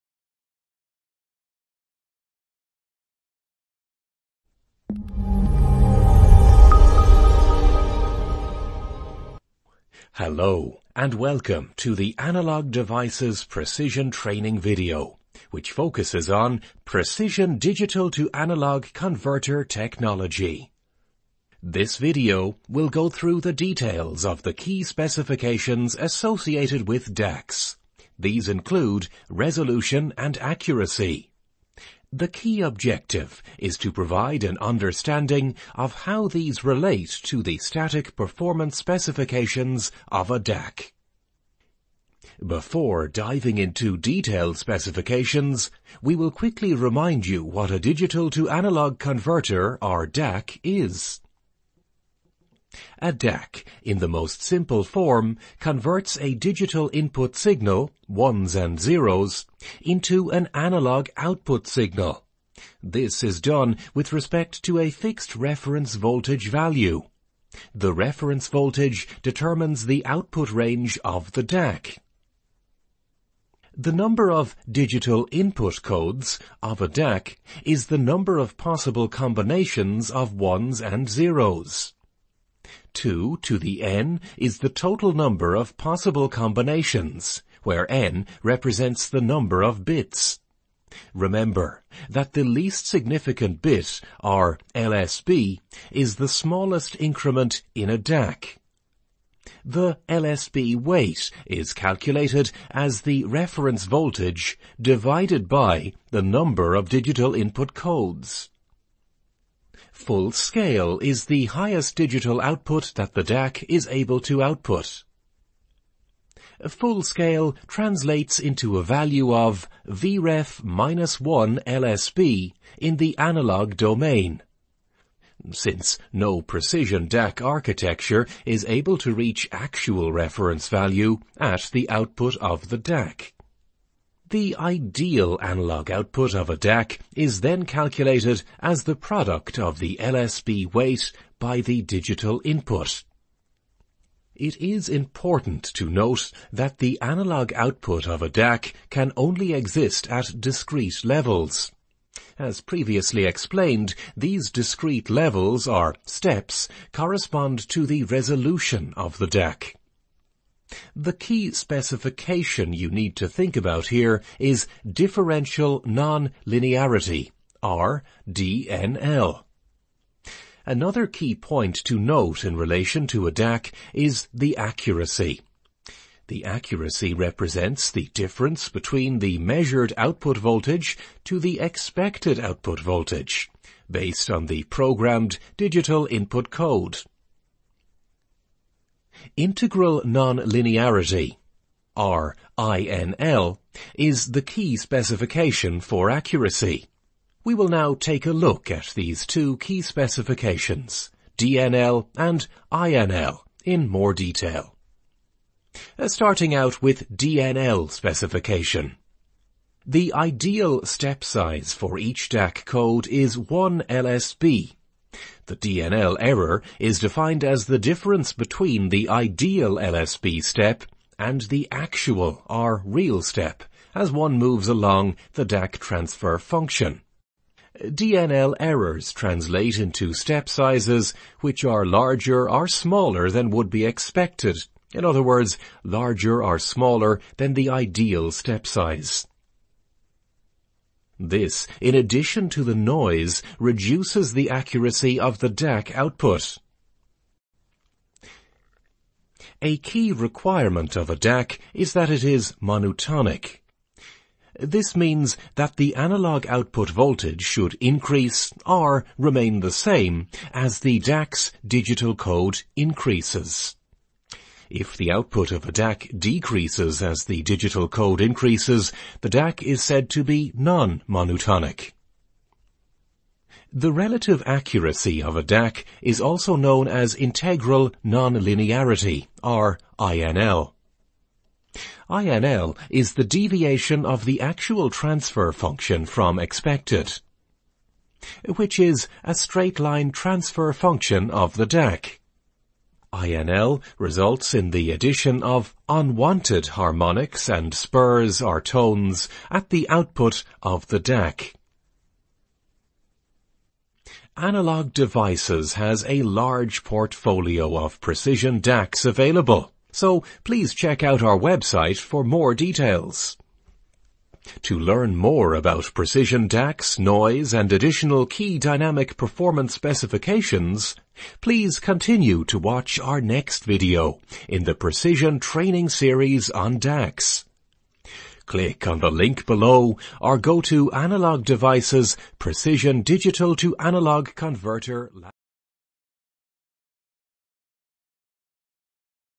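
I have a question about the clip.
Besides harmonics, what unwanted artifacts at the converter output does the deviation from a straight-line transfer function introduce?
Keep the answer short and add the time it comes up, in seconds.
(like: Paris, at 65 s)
spurs or tones, at 297 s.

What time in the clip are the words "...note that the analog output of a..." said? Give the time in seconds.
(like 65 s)
145 s.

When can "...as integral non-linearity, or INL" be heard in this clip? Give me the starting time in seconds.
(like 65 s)
276 s.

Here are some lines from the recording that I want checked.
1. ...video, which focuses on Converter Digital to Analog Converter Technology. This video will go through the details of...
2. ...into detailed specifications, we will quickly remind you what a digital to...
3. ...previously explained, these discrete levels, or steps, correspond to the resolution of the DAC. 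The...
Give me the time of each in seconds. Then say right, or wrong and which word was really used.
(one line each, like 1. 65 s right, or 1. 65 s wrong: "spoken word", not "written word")
1. 14 s wrong: "Precision", not "Converter"
2. 43 s right
3. 152 s right.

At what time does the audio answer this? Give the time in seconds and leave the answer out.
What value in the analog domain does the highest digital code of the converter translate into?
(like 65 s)
119 s.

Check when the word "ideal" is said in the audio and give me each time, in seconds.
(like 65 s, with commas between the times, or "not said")
134 s, 210 s, 219 s, 237 s.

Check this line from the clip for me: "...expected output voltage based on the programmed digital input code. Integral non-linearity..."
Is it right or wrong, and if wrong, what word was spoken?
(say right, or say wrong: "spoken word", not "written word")
right.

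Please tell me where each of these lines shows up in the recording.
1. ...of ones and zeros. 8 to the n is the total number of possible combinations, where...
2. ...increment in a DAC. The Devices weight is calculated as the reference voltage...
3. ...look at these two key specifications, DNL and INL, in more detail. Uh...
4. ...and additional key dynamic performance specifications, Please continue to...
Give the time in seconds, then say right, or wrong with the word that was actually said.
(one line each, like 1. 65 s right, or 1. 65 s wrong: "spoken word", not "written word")
1. 80 s wrong: "2", not "8"
2. 96 s wrong: "LSB", not "Devices"
3. 198 s right
4. 317 s right.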